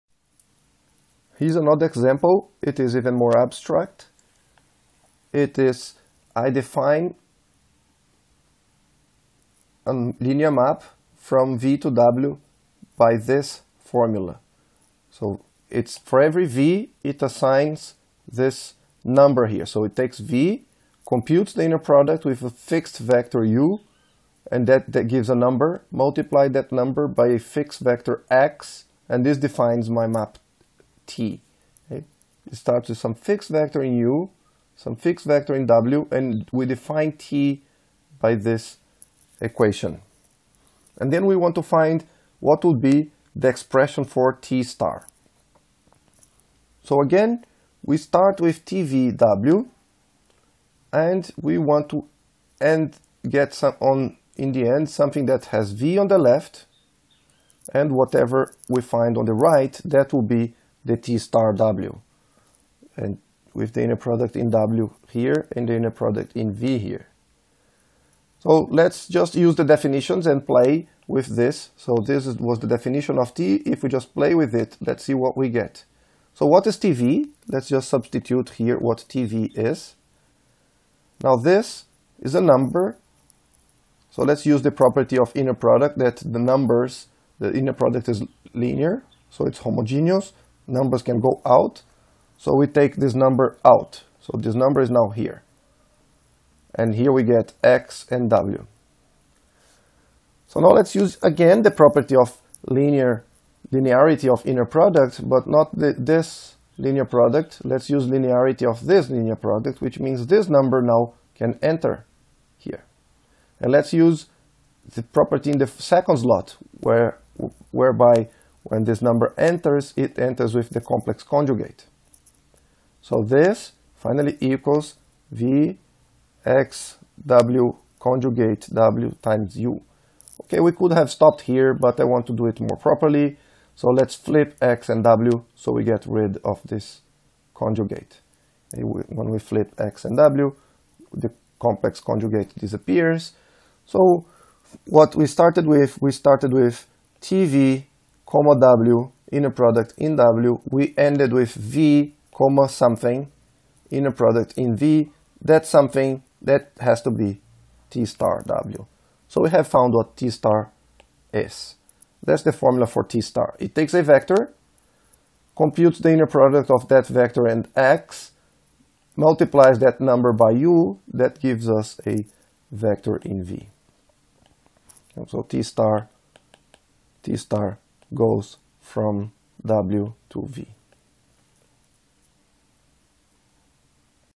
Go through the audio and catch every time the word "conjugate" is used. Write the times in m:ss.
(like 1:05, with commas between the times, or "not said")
2:01, 2:07, 2:17, 2:21.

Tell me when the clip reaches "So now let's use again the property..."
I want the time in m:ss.
1:40.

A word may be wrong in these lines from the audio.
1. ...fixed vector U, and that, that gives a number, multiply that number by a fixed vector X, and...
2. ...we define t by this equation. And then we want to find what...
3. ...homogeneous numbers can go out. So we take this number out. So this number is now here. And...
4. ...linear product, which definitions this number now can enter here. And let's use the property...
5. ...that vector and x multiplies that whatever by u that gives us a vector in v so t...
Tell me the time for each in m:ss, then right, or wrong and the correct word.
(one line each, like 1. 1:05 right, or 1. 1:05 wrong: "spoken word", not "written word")
1. 0:22 right
2. 0:36 right
3. 1:29 right
4. 1:49 wrong: "means", not "definitions"
5. 2:46 wrong: "number", not "whatever".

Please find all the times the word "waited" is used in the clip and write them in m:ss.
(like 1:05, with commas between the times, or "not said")
not said.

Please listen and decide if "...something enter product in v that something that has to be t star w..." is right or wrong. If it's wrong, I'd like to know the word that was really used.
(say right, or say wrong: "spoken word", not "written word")
wrong: "inner", not "enter".